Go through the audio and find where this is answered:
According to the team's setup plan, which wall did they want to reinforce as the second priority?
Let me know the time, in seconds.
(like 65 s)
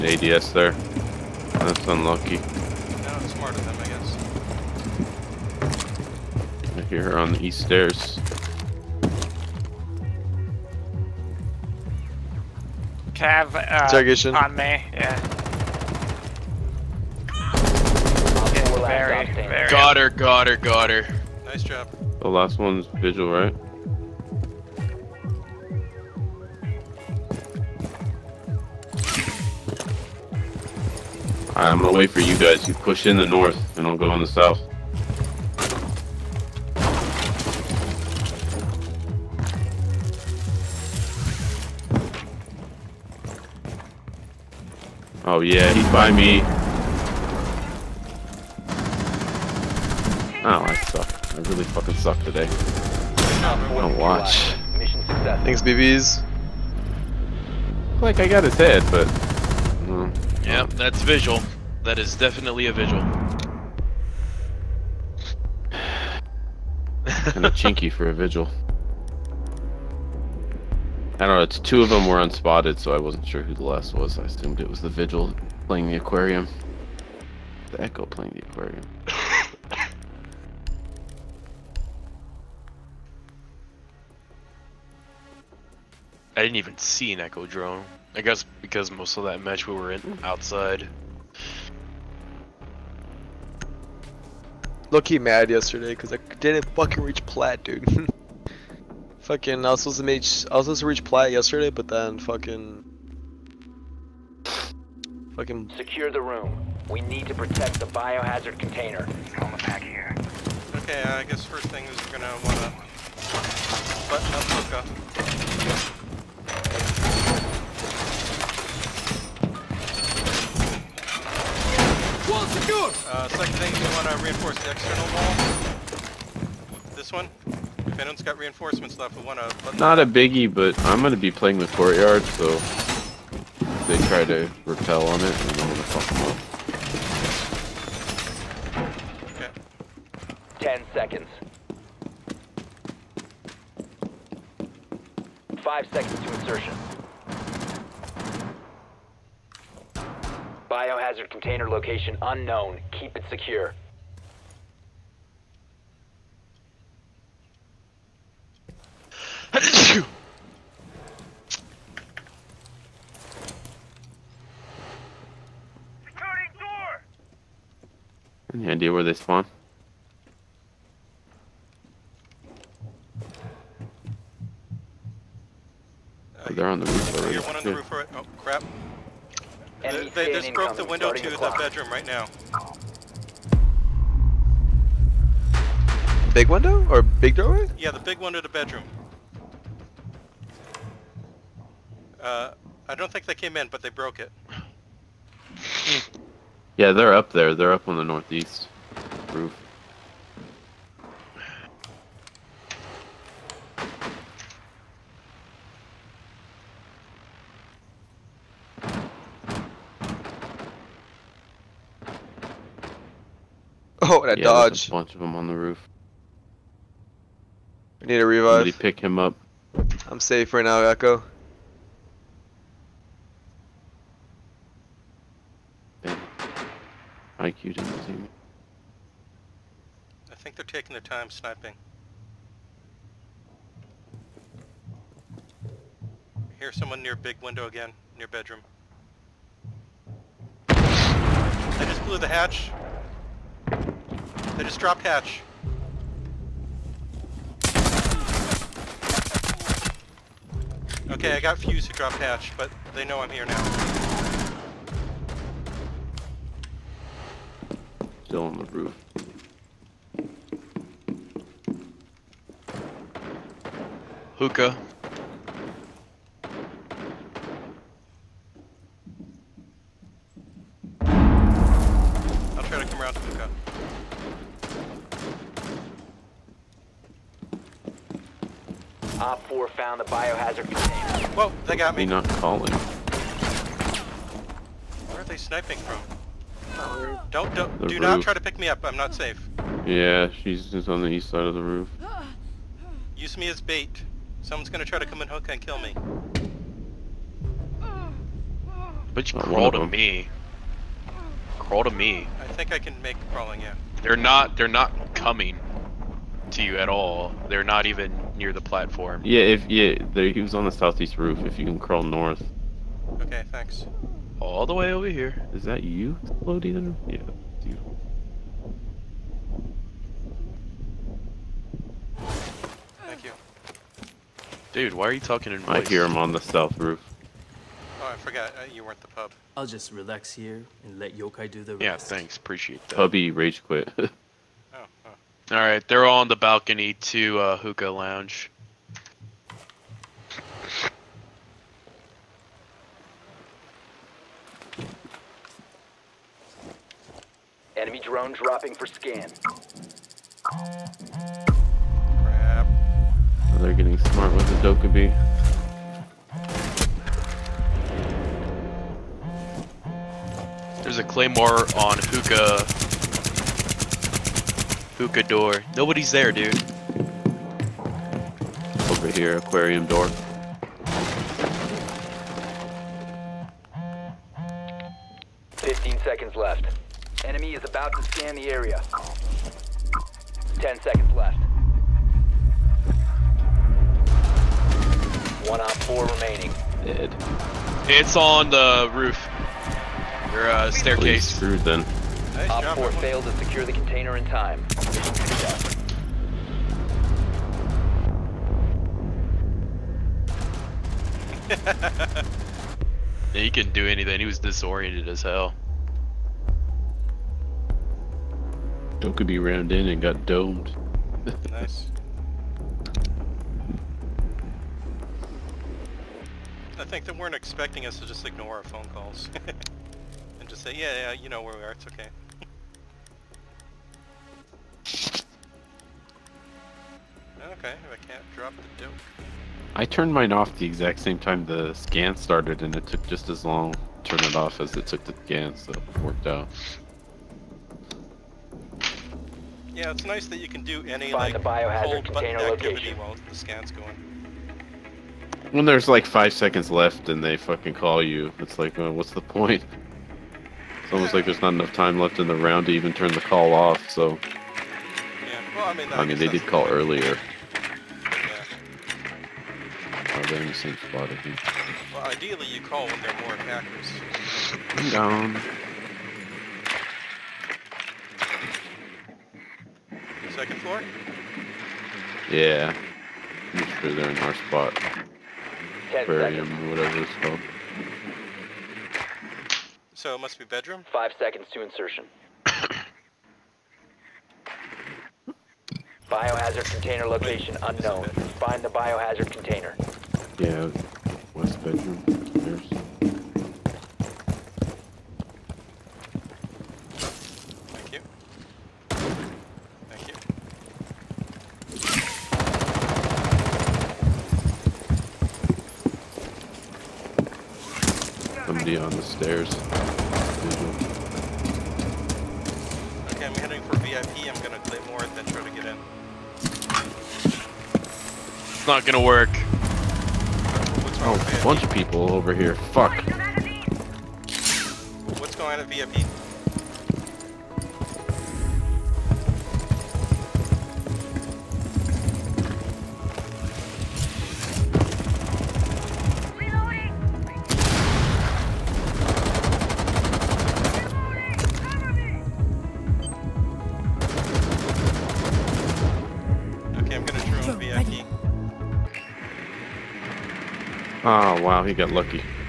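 124 s.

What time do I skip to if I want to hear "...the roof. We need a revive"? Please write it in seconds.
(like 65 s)
215 s.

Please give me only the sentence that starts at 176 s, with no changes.
Uh, they're on the roof already.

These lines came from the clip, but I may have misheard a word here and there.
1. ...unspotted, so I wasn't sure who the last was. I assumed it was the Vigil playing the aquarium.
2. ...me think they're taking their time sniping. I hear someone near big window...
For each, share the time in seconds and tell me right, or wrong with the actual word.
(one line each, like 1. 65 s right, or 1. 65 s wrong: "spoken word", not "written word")
1. 72 s right
2. 228 s right.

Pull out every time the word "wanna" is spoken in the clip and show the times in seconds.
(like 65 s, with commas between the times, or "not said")
112 s, 123 s, 129 s.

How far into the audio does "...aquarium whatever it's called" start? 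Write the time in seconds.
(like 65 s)
476 s.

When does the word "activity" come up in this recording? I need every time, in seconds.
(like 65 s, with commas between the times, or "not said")
442 s.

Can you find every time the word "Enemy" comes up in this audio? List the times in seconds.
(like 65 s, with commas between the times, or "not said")
347 s, 377 s.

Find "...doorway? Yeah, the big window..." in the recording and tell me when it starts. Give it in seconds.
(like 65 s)
187 s.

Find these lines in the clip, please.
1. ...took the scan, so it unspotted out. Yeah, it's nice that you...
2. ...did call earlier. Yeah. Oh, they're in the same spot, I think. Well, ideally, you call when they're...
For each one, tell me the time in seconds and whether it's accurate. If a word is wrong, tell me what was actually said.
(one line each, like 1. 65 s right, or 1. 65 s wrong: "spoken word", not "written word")
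1. 434 s wrong: "worked", not "unspotted"
2. 456 s right.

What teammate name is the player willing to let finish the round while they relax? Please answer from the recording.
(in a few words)
Yokai.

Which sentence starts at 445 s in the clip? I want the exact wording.
When there's like five seconds left and they fucking call you, it's like, well, uh, what's the point?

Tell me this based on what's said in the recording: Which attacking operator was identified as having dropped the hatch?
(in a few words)
Fuse.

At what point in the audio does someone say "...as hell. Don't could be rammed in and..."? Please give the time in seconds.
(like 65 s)
405 s.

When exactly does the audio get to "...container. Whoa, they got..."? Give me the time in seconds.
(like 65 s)
280 s.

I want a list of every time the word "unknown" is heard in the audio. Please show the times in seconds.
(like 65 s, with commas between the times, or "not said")
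152 s, 487 s.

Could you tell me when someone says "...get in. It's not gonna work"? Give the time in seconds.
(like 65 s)
515 s.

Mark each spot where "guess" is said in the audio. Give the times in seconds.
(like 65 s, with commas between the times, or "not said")
5 s, 88 s, 111 s.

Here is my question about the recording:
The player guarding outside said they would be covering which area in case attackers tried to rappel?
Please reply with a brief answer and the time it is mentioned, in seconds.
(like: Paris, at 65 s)
Courtyard, at 131 s.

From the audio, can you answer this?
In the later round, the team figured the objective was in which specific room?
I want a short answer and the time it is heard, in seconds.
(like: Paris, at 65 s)
West bedroom, at 491 s.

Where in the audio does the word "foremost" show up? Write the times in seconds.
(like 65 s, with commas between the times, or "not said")
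not said.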